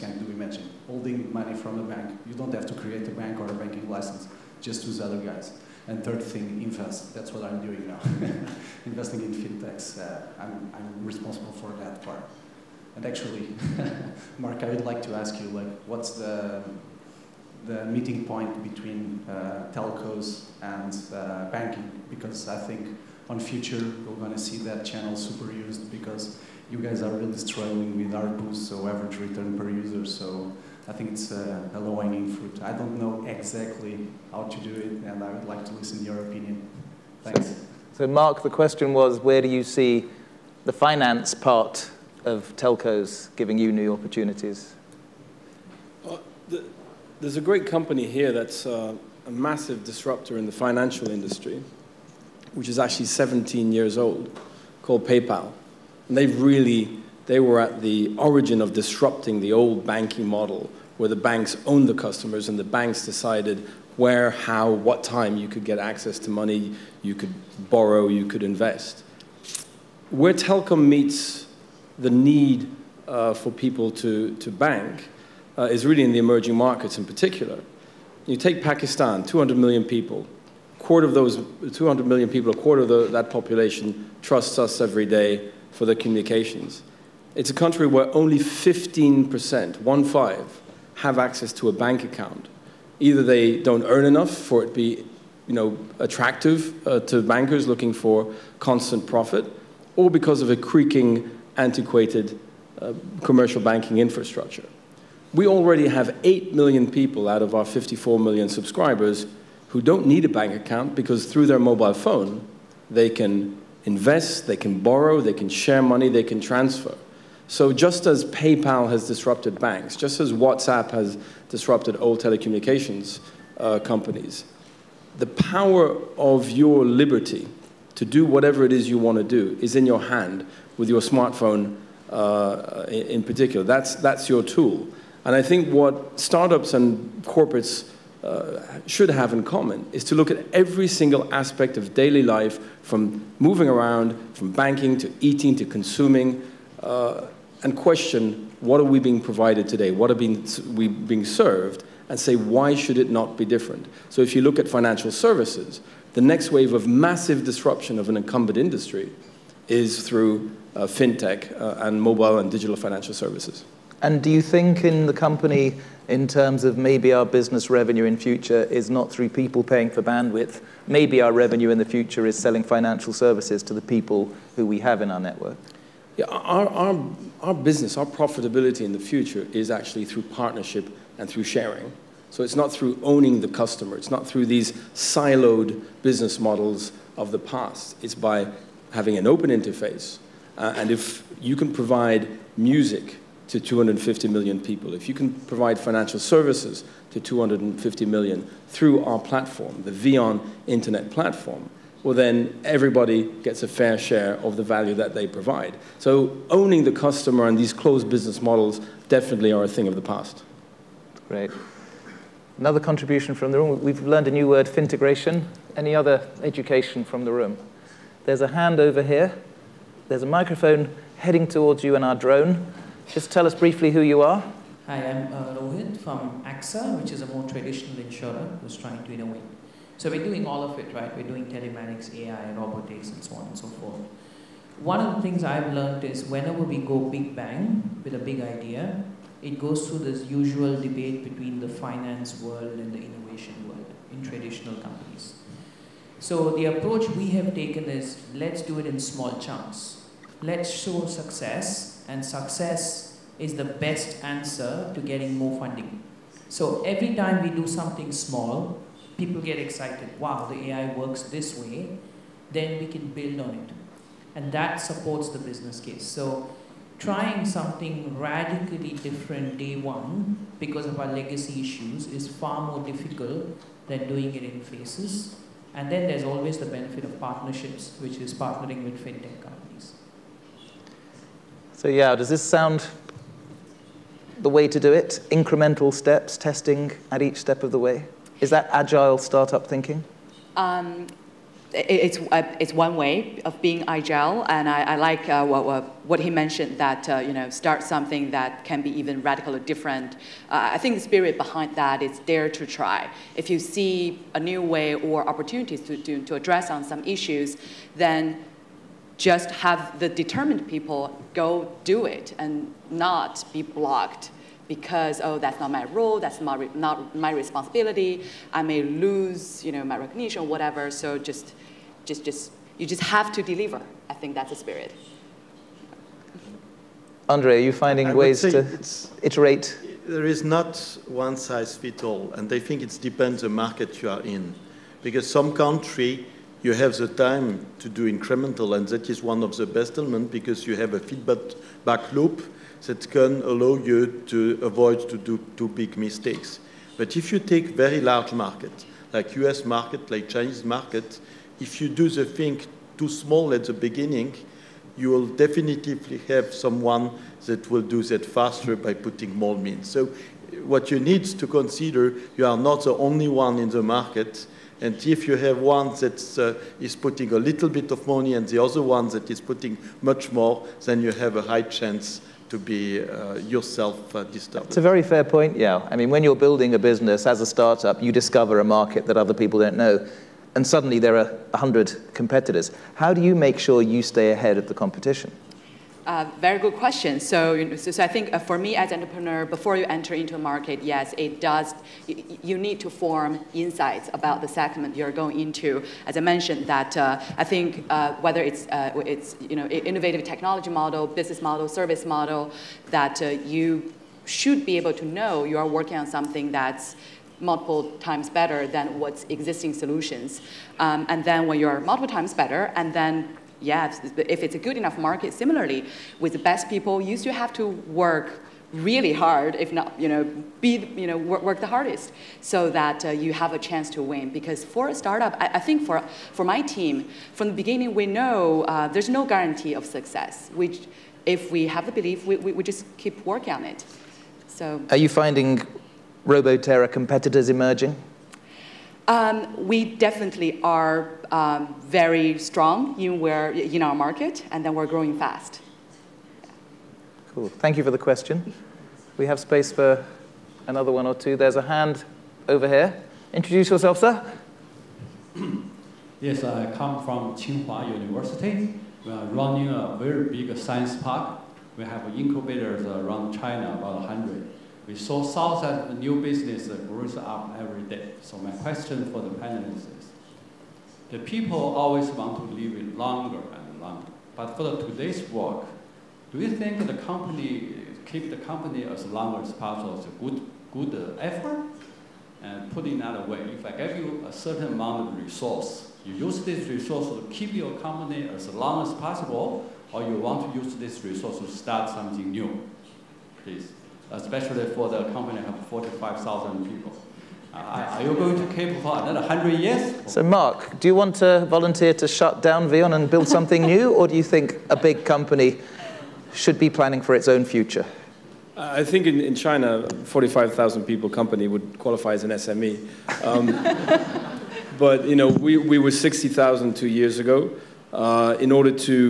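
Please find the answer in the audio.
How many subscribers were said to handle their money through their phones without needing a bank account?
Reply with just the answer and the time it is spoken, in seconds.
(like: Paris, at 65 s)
8 million, at 106 s.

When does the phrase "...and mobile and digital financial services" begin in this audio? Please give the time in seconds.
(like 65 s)
161 s.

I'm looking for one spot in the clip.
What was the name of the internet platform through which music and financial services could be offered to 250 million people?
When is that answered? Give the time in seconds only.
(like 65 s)
199 s.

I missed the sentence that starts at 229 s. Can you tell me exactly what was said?
So we're doing all of it, right?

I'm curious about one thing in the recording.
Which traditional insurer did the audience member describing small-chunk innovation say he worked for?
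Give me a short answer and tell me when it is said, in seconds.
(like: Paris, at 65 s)
AXA, at 226 s.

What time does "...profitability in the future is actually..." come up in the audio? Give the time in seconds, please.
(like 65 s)
178 s.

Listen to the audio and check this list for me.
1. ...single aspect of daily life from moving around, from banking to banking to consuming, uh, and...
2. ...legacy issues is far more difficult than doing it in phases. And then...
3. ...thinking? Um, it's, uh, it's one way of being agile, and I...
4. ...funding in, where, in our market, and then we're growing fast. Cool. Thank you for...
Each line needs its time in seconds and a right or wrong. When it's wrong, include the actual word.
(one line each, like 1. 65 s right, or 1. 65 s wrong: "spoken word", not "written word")
1. 140 s wrong: "eating", not "banking"
2. 271 s right
3. 289 s right
4. 442 s wrong: "strong", not "funding".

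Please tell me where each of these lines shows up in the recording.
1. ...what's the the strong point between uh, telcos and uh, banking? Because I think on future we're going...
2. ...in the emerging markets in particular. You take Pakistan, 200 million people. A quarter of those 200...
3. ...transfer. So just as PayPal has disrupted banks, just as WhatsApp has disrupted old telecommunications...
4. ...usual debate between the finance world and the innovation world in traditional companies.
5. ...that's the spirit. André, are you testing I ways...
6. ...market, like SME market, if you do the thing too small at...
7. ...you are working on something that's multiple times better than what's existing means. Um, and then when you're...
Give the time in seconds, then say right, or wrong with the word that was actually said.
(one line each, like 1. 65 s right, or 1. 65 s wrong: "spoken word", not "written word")
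1. 15 s wrong: "meeting", not "strong"
2. 76 s right
3. 116 s right
4. 240 s right
5. 324 s wrong: "finding", not "testing"
6. 349 s wrong: "Chinese", not "SME"
7. 405 s wrong: "solutions", not "means".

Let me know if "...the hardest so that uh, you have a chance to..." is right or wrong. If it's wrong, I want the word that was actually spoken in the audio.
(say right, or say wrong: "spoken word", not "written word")
right.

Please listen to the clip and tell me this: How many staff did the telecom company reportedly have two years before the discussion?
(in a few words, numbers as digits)
60,000.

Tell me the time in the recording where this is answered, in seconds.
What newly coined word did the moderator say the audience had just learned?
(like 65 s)
214 s.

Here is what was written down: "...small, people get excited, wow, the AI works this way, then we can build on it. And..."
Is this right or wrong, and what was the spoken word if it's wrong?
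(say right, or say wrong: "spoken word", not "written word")
right.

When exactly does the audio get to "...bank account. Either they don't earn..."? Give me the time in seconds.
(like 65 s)
91 s.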